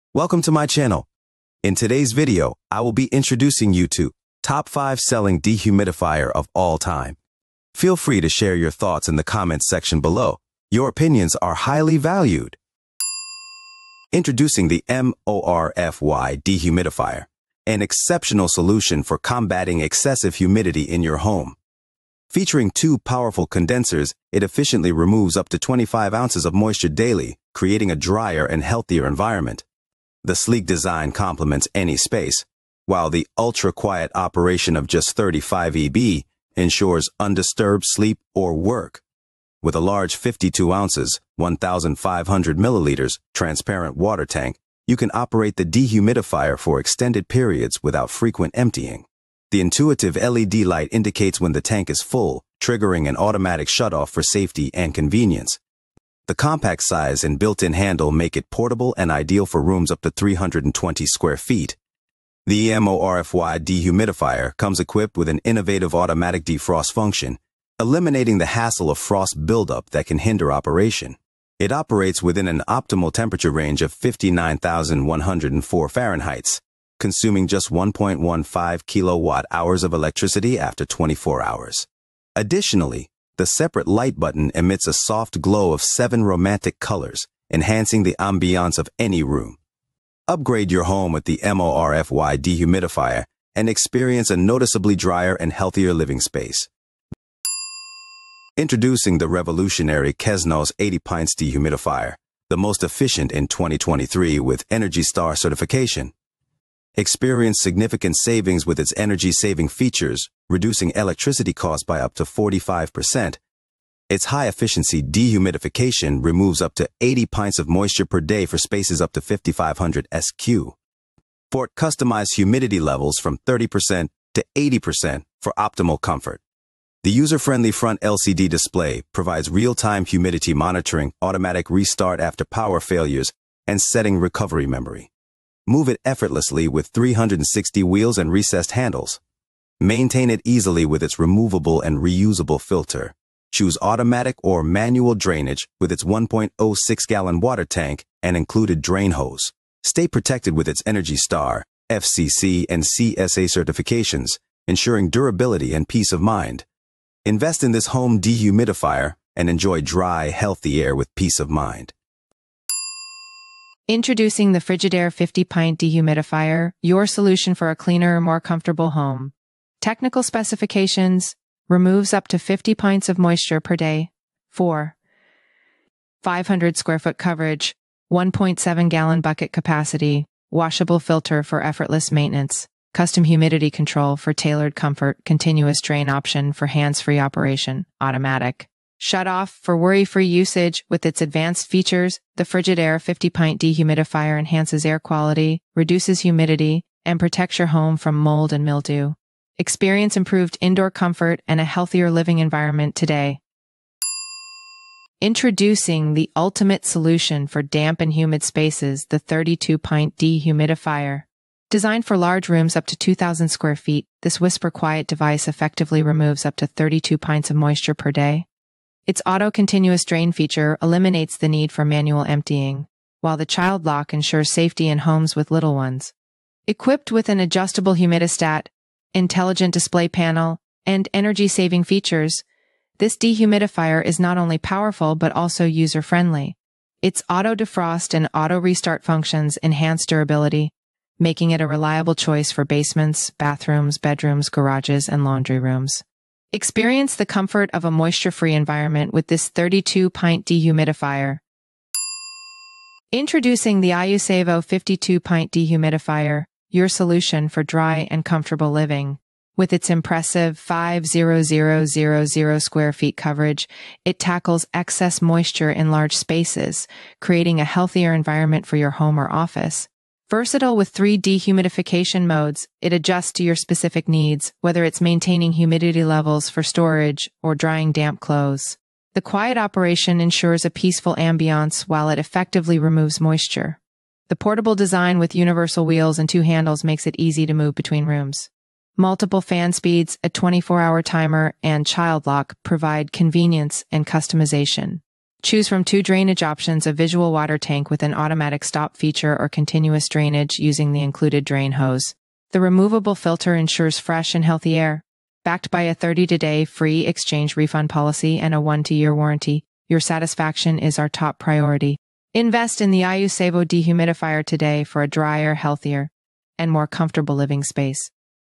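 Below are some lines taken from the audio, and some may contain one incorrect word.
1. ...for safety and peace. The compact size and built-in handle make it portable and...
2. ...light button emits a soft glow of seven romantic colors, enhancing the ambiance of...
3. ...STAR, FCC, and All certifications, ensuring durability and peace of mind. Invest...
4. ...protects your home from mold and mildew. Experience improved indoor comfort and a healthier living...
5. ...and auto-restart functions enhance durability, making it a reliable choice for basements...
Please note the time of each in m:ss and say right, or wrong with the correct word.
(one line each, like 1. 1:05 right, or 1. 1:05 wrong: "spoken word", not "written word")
1. 0:54 wrong: "convenience", not "peace"
2. 1:23 right
3. 2:31 wrong: "CSA", not "All"
4. 3:17 right
5. 3:58 right.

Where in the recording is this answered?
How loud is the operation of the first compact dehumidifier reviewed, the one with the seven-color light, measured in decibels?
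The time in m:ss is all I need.
0:35.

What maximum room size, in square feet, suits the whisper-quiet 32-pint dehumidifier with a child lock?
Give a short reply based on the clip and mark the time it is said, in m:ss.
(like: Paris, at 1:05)
2,000 square feet, at 3:32.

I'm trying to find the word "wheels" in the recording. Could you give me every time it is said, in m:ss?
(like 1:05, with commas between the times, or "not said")
2:17, 4:45.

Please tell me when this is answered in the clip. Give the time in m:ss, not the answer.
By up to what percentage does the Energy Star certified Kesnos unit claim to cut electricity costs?
1:52.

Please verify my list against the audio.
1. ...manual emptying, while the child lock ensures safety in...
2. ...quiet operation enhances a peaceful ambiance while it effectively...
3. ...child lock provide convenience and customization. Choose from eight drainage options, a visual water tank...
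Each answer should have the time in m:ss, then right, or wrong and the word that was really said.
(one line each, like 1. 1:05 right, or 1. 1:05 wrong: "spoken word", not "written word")
1. 3:41 right
2. 4:39 wrong: "ensures", not "enhances"
3. 4:51 wrong: "two", not "eight".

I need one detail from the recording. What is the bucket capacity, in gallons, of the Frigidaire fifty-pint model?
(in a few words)
1.7 gallons.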